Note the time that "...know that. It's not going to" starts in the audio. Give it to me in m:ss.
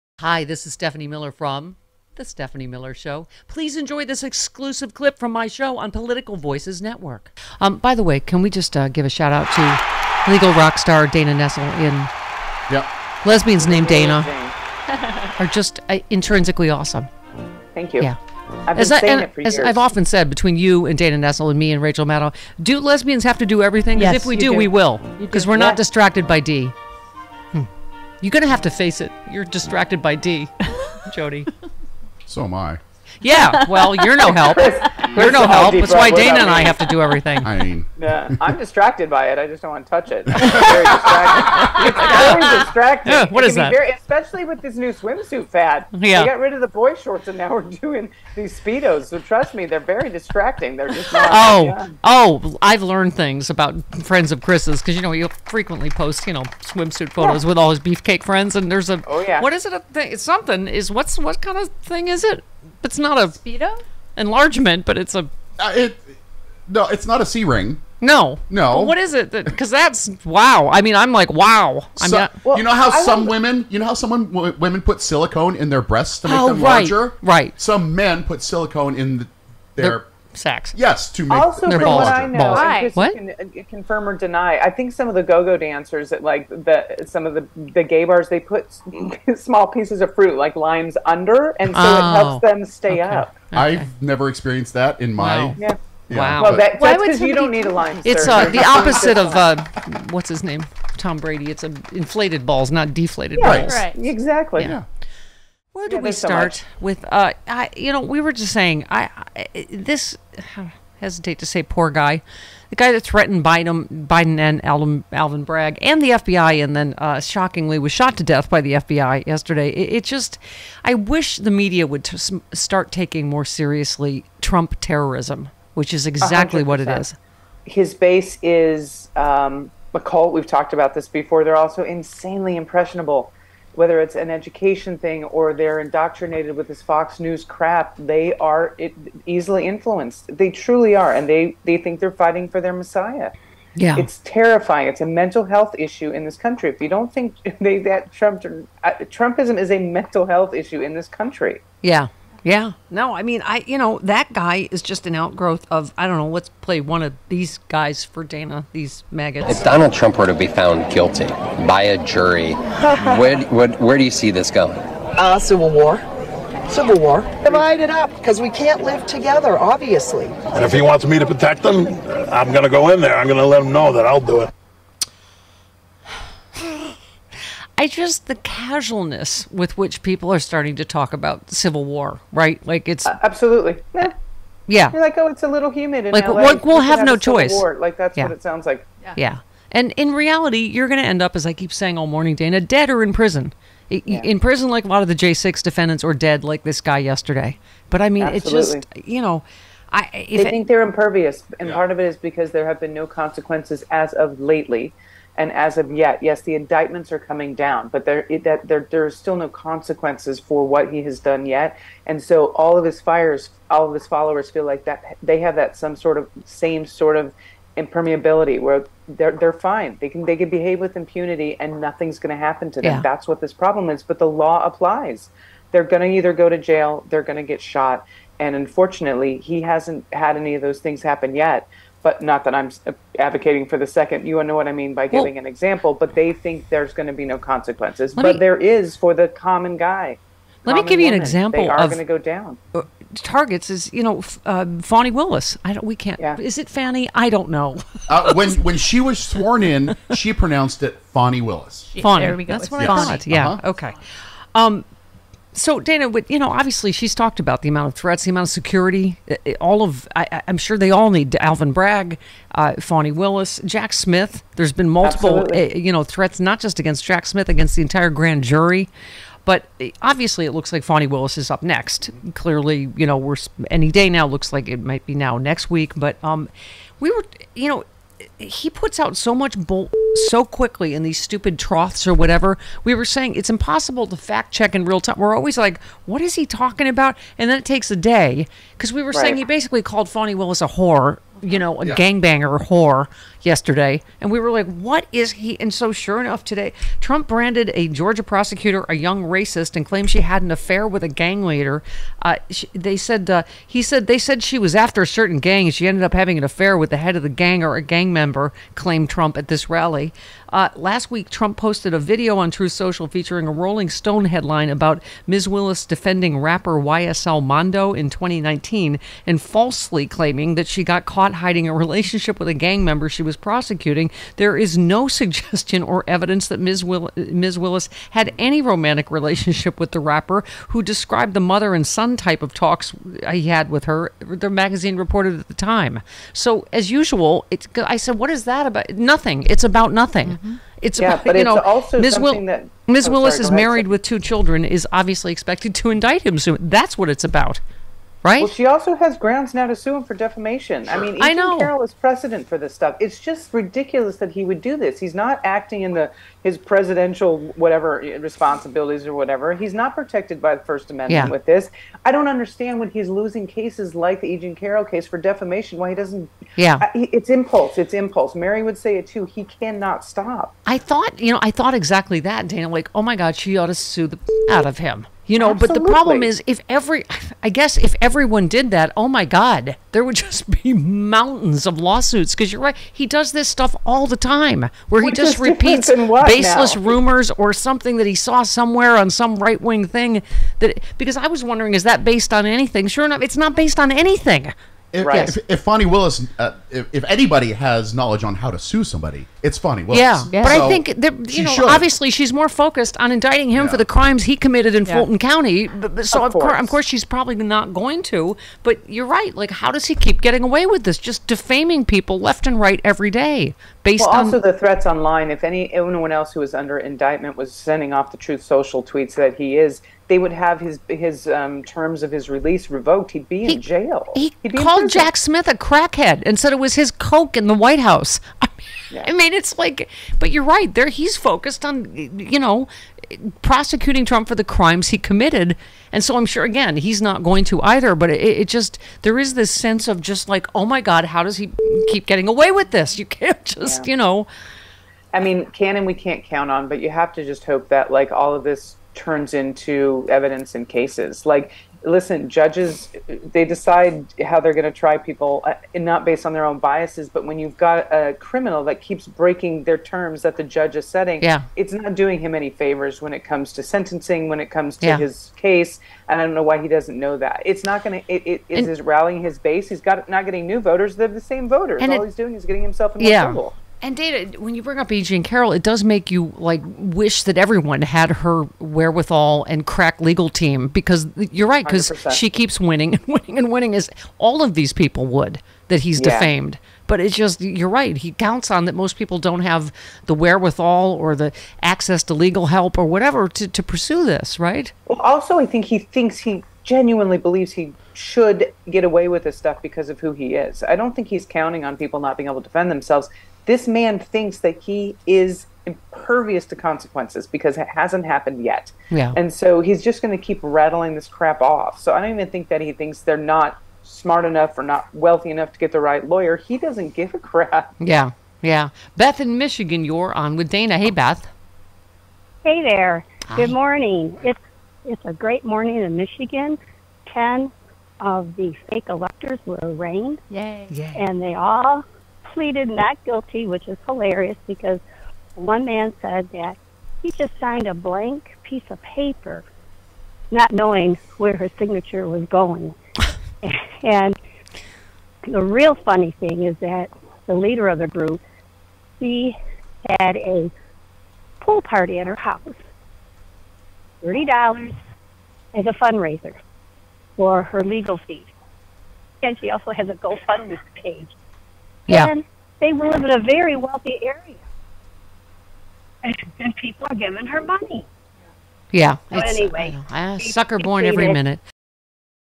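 7:46.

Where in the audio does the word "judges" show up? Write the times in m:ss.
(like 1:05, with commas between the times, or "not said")
7:32, 7:40.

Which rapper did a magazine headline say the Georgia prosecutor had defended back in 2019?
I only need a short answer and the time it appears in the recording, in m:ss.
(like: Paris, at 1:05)
YSL Mondo, at 5:16.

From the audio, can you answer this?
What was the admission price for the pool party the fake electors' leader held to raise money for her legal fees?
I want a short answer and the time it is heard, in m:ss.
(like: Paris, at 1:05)
$30, at 9:14.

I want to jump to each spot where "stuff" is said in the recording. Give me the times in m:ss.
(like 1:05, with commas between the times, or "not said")
5:52, 6:23, 8:19.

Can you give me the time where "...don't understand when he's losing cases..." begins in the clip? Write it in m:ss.
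6:02.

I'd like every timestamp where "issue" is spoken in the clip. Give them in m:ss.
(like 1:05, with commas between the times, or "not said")
2:25, 2:30.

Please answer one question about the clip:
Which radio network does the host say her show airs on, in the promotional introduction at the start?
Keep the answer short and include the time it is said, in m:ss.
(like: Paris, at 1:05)
Political Voices Network, at 0:05.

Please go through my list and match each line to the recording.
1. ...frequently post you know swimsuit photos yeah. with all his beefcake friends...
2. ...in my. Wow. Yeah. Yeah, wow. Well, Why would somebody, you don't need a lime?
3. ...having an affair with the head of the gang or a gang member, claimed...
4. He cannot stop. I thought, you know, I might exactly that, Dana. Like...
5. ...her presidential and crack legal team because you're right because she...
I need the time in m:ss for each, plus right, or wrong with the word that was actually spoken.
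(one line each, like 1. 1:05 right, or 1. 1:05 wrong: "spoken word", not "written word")
1. 0:55 right
2. 1:35 right
3. 5:06 right
4. 6:09 wrong: "thought", not "might"
5. 7:58 wrong: "wherewithal", not "presidential".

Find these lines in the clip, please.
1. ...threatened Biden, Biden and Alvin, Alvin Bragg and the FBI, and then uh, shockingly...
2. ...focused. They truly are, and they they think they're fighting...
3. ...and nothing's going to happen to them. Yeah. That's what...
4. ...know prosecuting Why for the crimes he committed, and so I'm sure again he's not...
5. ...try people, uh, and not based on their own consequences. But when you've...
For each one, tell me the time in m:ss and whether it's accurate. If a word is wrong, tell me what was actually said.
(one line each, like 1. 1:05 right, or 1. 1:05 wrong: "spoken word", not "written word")
1. 1:53 right
2. 2:19 wrong: "influenced", not "focused"
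3. 3:41 right
4. 7:12 wrong: "Trump", not "Why"
5. 7:34 wrong: "biases", not "consequences".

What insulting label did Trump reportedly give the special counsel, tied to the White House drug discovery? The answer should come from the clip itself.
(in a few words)
crackhead.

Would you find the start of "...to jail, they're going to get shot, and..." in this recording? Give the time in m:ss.
3:46.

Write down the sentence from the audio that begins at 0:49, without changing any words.
So trust me, they're very distracting.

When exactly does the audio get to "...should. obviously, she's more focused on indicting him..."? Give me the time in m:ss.
6:41.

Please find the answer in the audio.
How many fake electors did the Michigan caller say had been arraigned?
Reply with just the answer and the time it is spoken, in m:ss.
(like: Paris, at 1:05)
10, at 8:47.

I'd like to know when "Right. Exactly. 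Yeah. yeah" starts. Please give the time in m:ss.
1:43.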